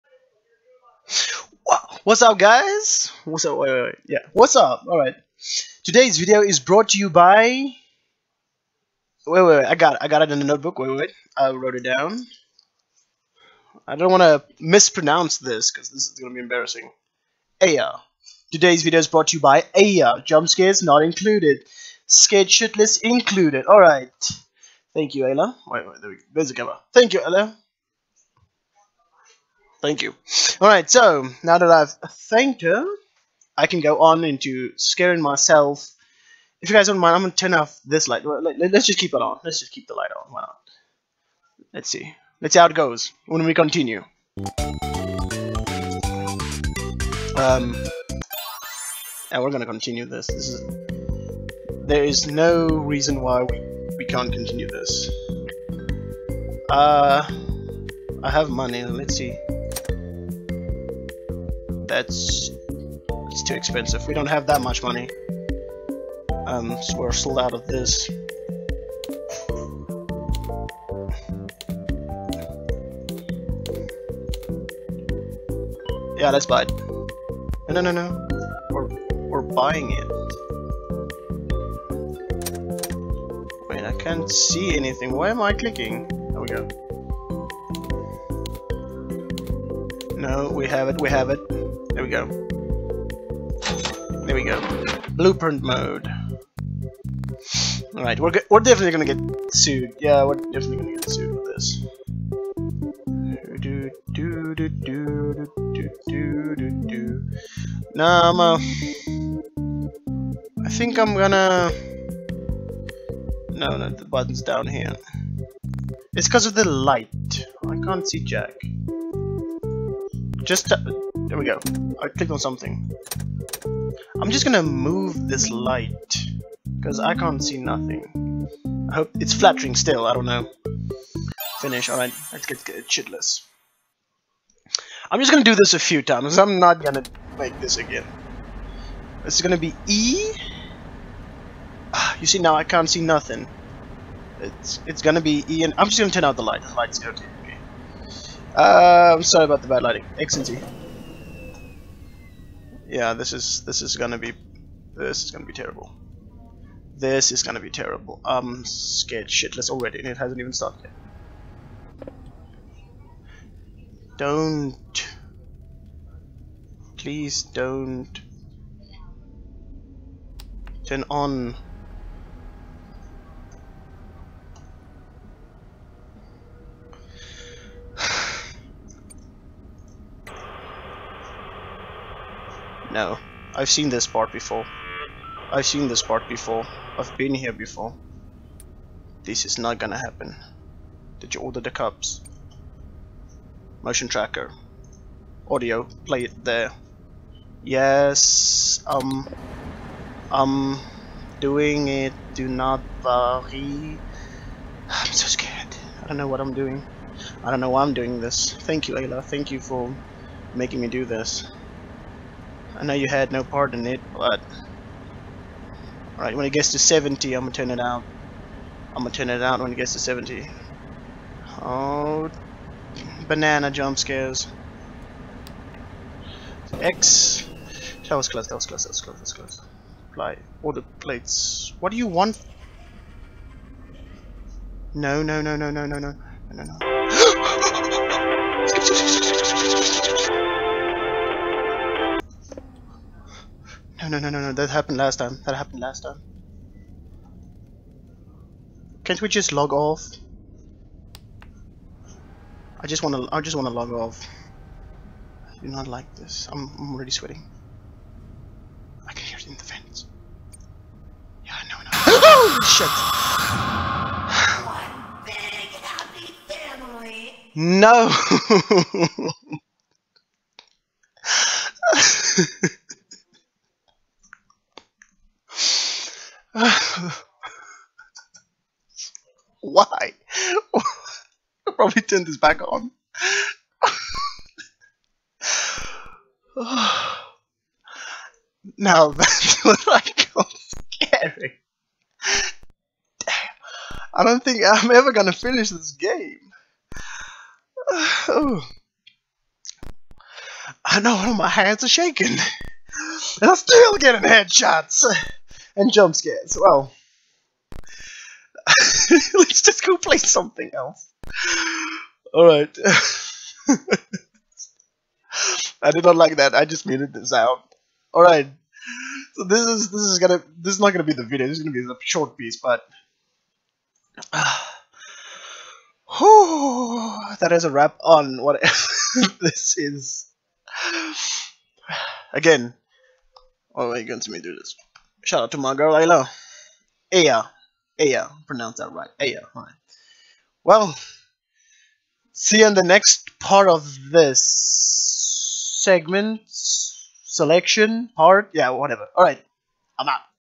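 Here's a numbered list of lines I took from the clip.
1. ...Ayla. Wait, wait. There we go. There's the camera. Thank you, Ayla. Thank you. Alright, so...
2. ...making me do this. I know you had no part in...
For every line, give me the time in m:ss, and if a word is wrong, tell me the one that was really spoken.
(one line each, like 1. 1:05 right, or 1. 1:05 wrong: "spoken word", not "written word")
1. 0:25 right
2. 3:30 right.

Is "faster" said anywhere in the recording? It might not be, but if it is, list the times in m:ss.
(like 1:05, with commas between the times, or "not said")
not said.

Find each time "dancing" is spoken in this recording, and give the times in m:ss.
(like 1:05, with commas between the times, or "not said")
not said.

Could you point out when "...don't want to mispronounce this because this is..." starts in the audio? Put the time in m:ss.
0:13.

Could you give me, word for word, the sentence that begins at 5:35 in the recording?
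shout out to my girl Ayla.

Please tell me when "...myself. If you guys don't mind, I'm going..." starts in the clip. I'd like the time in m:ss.
0:35.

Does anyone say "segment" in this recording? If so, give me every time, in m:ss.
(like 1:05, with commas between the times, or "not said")
5:45.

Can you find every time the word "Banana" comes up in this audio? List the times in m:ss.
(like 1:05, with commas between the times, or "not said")
3:43.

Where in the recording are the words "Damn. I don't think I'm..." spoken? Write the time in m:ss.
4:53.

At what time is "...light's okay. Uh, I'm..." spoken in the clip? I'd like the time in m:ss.
2:26.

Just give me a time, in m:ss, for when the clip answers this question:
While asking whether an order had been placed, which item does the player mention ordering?
3:11.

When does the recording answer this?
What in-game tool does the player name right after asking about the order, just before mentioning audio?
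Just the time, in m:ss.
3:13.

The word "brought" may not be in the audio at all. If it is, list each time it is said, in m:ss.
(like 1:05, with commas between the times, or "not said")
0:06, 0:19.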